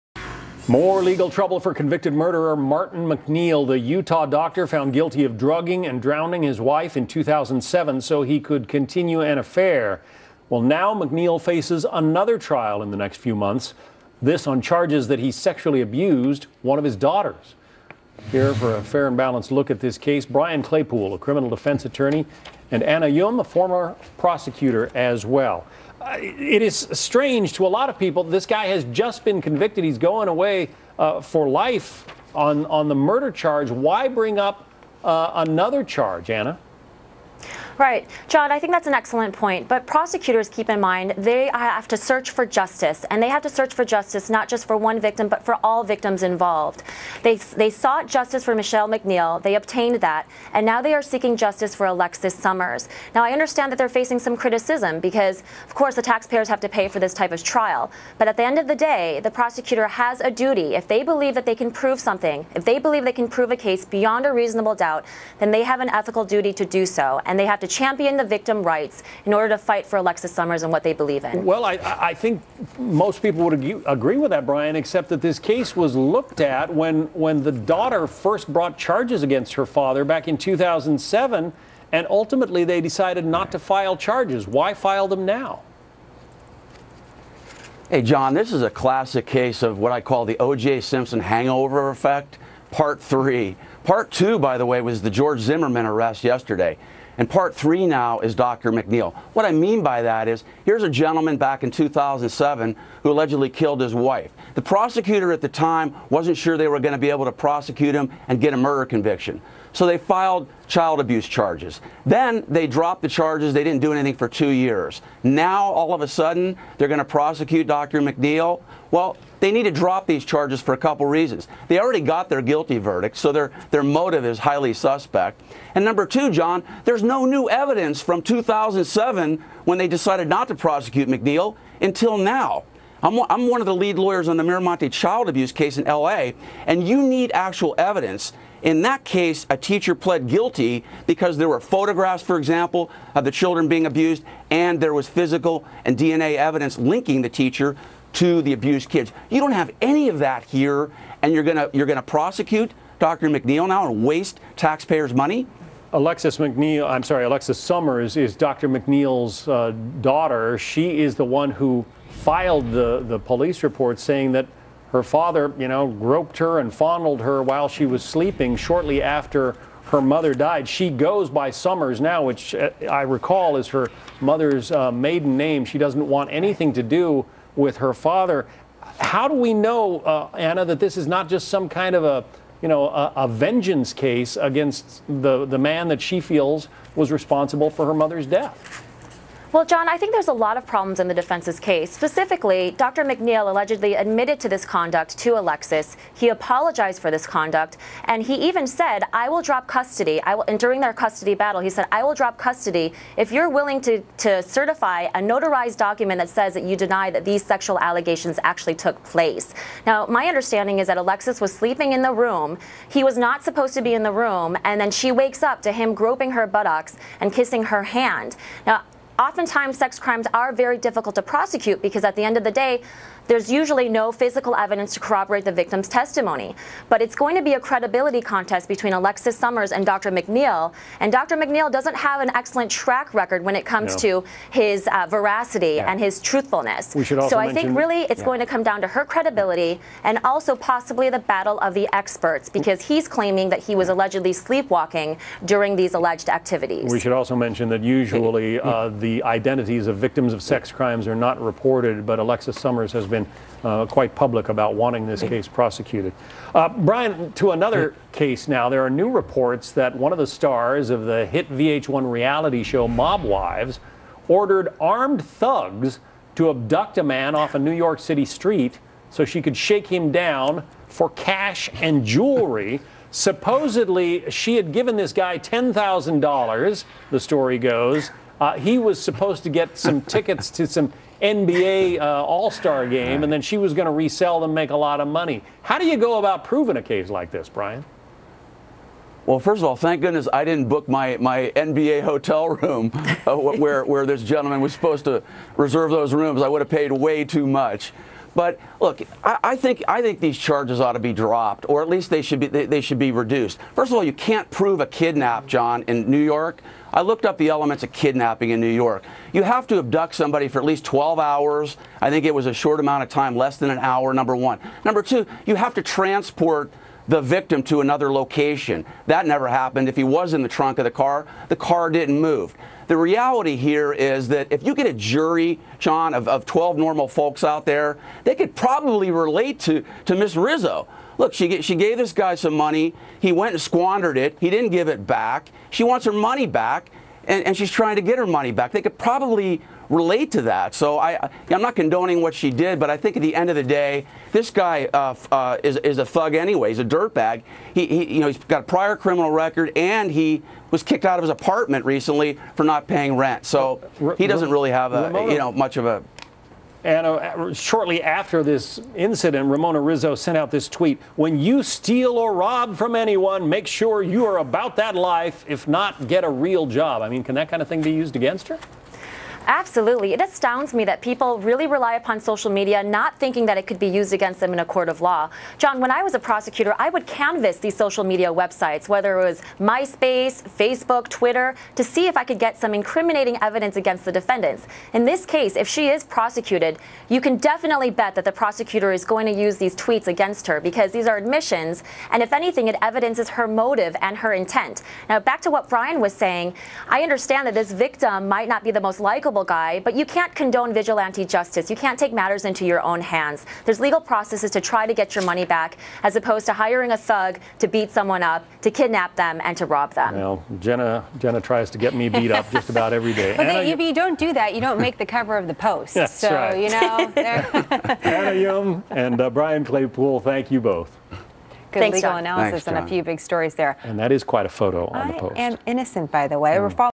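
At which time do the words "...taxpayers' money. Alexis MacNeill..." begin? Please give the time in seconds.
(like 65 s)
154 s.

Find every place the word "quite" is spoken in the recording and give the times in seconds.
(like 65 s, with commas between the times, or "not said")
253 s, 424 s.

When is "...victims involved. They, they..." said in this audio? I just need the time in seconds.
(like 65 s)
45 s.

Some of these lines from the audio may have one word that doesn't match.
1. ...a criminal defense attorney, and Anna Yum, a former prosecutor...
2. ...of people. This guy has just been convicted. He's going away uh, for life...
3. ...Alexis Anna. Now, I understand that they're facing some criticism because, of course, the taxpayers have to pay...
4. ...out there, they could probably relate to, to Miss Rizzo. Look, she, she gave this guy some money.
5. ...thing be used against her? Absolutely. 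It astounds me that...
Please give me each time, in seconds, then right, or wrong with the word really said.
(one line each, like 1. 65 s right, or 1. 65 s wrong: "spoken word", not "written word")
1. 21 s right
2. 27 s right
3. 51 s wrong: "Somers", not "Anna"
4. 327 s right
5. 367 s right.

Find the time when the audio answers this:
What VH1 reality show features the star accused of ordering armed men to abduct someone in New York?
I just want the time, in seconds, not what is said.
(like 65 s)
262 s.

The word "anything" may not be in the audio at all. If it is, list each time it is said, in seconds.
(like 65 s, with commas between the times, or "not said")
113 s, 176 s, 392 s.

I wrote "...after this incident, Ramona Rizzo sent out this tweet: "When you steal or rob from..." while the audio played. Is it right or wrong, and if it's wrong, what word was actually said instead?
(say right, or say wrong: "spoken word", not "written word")
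right.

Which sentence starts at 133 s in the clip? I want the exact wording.
I'm, I'm one of the lead lawyers on the Miramonte child abuse case in LA, and you need actual evidence.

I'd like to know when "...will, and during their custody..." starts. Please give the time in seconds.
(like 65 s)
200 s.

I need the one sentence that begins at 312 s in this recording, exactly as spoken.
I think it was a short amount of time, less than an hour.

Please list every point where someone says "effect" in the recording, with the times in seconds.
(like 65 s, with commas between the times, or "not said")
91 s.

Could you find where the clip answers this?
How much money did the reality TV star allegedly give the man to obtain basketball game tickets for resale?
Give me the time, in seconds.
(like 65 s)
275 s.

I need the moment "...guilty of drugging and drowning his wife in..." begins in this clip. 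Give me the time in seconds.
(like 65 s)
4 s.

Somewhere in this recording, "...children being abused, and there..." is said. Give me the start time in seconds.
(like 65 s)
143 s.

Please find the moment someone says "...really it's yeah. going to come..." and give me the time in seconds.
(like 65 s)
237 s.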